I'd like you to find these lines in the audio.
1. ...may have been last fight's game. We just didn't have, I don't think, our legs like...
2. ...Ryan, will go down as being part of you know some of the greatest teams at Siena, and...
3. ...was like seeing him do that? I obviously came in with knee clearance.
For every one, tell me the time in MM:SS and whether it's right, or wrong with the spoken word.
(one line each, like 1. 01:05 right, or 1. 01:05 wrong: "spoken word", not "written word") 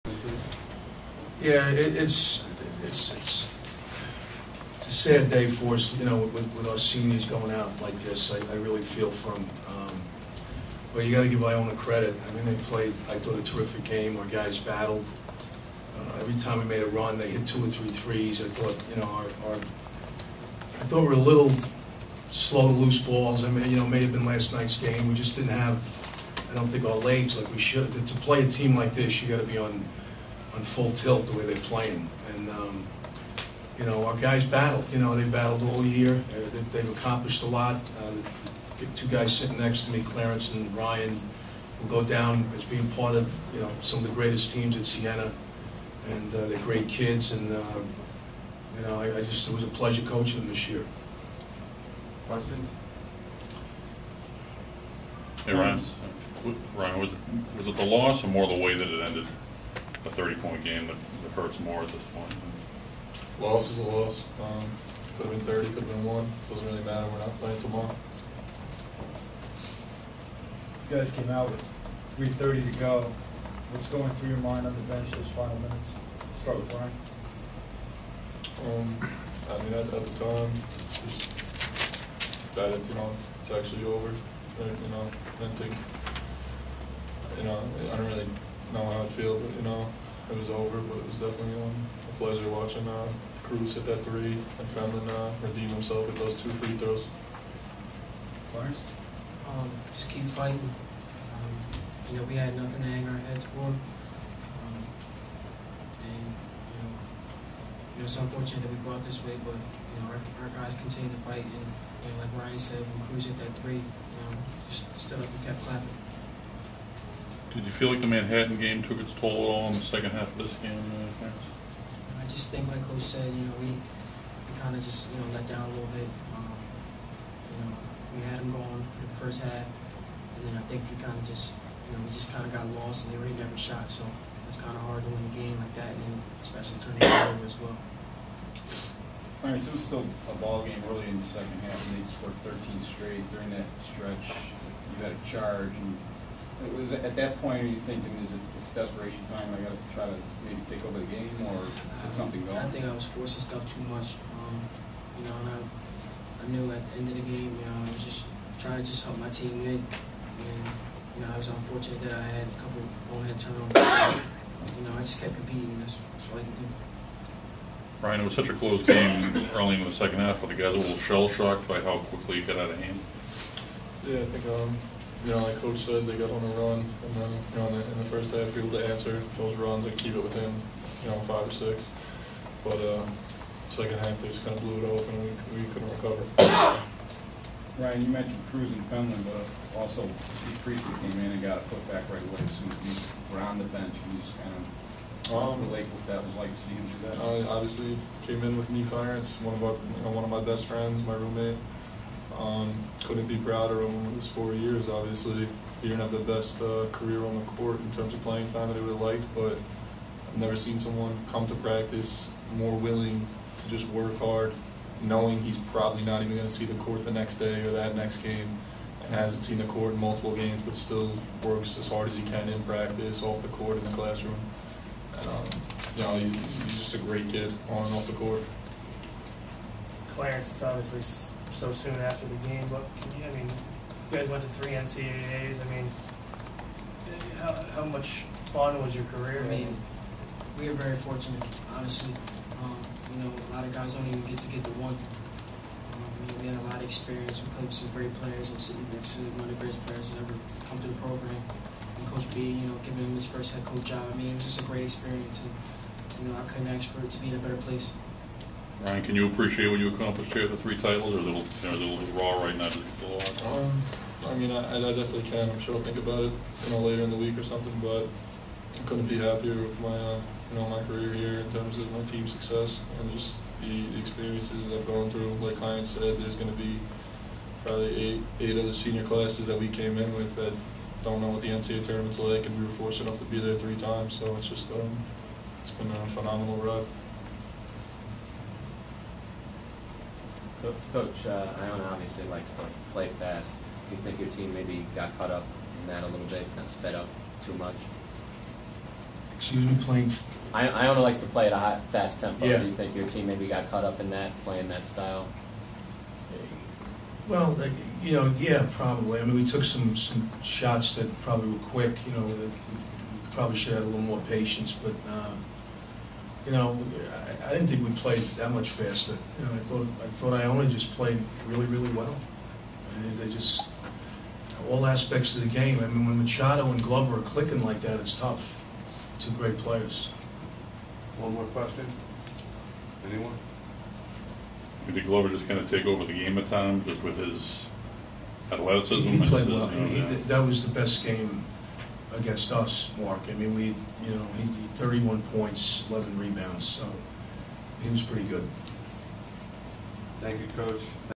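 1. 00:23 wrong: "night", not "fight"
2. 00:40 right
3. 03:16 right.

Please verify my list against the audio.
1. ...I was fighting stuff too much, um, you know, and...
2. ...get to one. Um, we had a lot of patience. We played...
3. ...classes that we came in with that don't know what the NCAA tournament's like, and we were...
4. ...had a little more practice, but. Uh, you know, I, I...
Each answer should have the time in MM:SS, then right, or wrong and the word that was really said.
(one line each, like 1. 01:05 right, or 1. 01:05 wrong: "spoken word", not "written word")
1. 02:32 wrong: "forcing", not "fighting"
2. 04:04 wrong: "experience", not "patience"
3. 04:39 right
4. 05:13 wrong: "patience", not "practice".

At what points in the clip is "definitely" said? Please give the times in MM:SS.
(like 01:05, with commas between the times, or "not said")
01:31, 04:24.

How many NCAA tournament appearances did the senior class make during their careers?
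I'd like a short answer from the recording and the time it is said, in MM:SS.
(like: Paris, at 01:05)
3, at 03:54.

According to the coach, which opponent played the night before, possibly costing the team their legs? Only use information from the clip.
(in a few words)
Manhattan.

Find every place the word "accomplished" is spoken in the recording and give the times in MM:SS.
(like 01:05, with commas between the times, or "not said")
00:36, 04:19.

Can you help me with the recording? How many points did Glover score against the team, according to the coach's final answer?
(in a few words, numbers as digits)
31.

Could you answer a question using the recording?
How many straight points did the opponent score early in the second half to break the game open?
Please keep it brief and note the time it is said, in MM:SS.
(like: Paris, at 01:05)
13, at 02:22.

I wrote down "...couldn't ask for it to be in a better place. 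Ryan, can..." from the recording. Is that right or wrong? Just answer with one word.
right.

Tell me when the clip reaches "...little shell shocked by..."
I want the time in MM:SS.
02:50.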